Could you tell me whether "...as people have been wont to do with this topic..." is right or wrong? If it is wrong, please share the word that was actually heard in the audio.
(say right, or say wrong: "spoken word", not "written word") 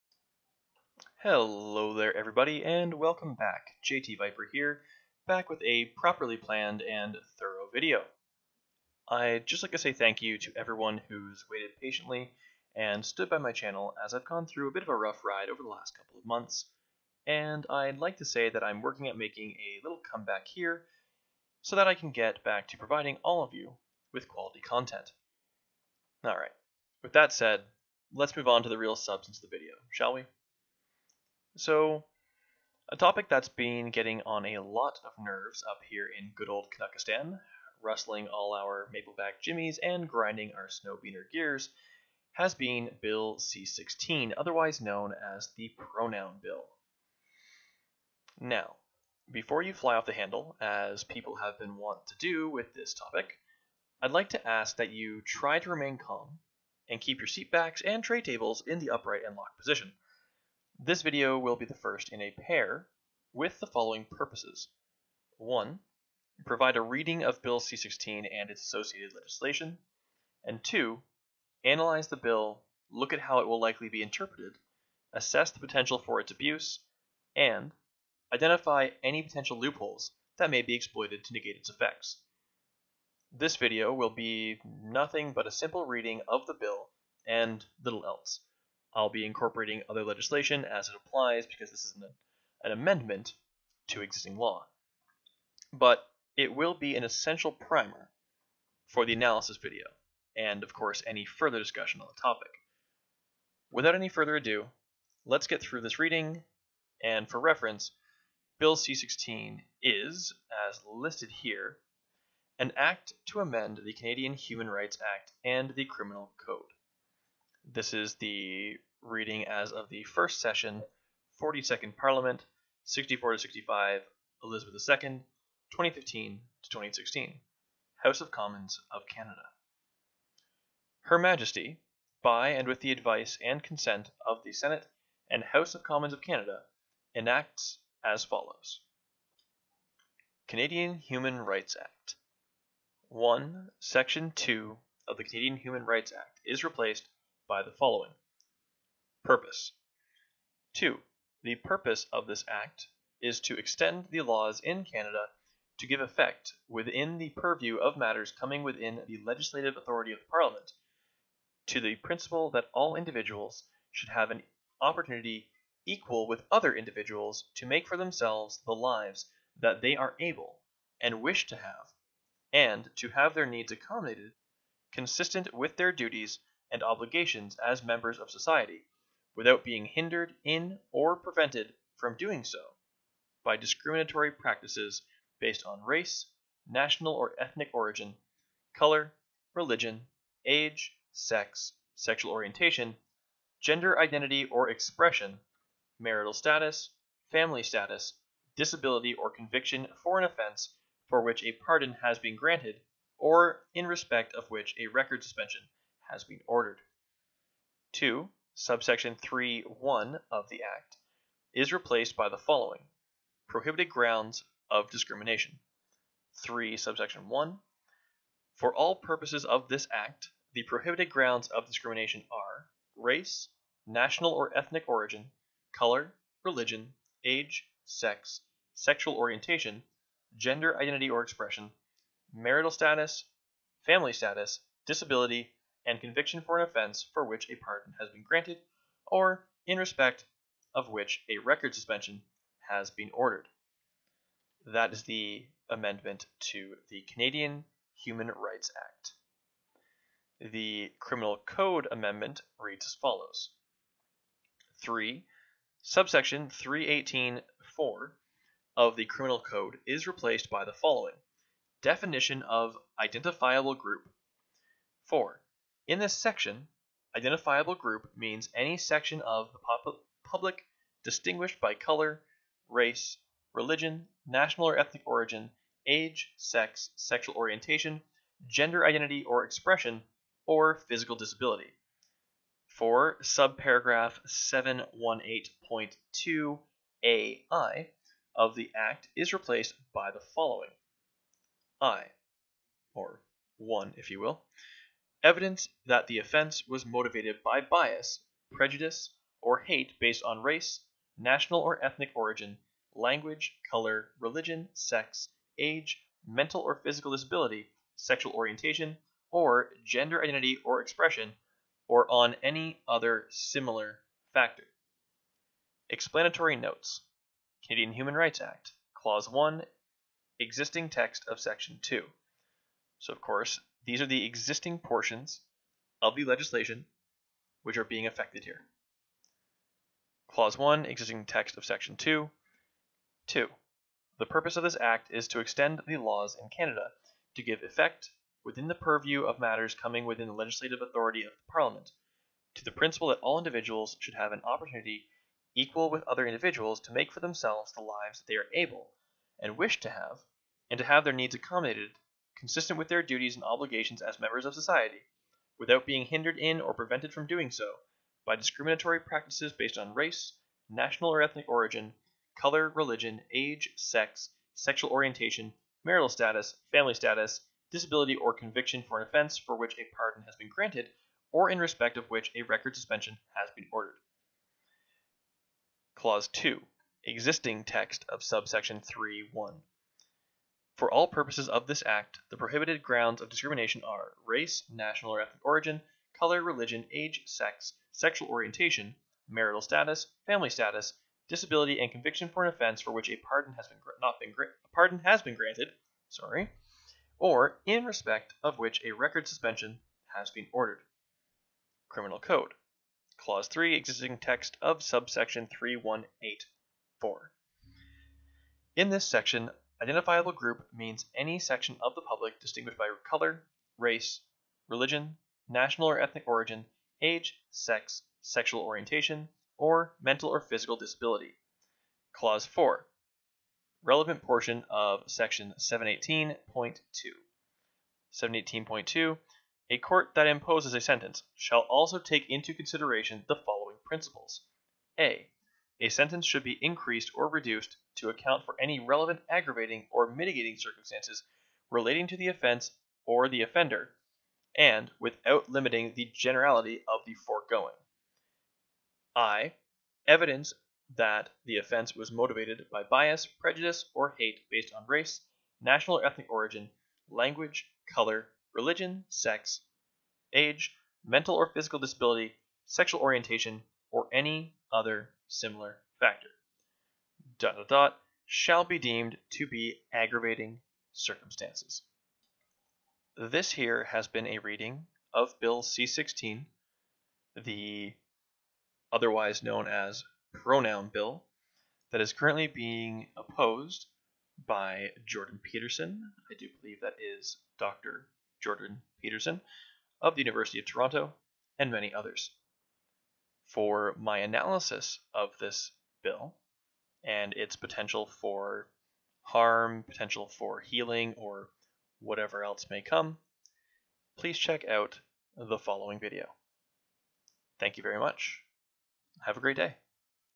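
right.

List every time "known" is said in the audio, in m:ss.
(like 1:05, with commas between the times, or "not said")
0:44, 7:59.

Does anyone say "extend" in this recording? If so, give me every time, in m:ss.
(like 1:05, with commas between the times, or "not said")
2:33, 5:35.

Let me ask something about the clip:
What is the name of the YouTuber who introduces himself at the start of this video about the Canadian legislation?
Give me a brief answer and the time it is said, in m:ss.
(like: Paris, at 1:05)
JT Viper, at 0:03.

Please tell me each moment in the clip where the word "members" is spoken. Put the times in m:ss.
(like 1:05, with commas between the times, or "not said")
2:57, 5:54.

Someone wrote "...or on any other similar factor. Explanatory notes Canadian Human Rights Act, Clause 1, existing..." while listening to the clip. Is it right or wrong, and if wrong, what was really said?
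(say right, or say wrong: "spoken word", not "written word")
right.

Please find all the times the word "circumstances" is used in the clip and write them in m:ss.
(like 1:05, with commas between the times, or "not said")
7:20, 7:50.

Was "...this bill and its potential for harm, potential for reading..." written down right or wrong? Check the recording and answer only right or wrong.
wrong.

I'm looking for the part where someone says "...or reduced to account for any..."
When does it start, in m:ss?
7:17.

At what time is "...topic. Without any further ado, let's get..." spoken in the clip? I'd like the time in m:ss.
1:42.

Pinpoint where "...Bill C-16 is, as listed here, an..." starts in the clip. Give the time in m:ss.
1:48.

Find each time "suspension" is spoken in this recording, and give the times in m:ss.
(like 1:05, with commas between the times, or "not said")
3:25, 4:01, 6:12, 6:39.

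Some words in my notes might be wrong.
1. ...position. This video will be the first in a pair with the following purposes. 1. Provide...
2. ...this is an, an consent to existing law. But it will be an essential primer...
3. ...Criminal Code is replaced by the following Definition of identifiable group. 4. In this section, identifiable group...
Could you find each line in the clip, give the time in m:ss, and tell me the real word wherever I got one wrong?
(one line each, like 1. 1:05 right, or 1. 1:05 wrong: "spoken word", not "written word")
1. 0:59 right
2. 1:31 wrong: "amendment", not "consent"
3. 4:19 right.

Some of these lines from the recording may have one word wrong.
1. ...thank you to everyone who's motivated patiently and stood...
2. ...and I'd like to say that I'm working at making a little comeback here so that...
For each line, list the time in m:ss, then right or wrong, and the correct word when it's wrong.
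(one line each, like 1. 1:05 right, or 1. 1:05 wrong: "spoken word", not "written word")
1. 0:09 wrong: "waited", not "motivated"
2. 0:17 right.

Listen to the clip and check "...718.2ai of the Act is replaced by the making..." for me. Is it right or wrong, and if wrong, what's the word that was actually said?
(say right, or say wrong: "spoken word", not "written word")
wrong: "following", not "making".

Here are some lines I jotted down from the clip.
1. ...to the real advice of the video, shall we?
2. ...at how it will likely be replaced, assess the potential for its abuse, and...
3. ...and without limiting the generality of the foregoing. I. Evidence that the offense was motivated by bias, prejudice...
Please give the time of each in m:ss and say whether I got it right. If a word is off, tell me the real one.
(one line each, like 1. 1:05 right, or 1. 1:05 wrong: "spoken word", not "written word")
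1. 0:28 wrong: "substance", not "advice"
2. 1:13 wrong: "interpreted", not "replaced"
3. 7:24 right.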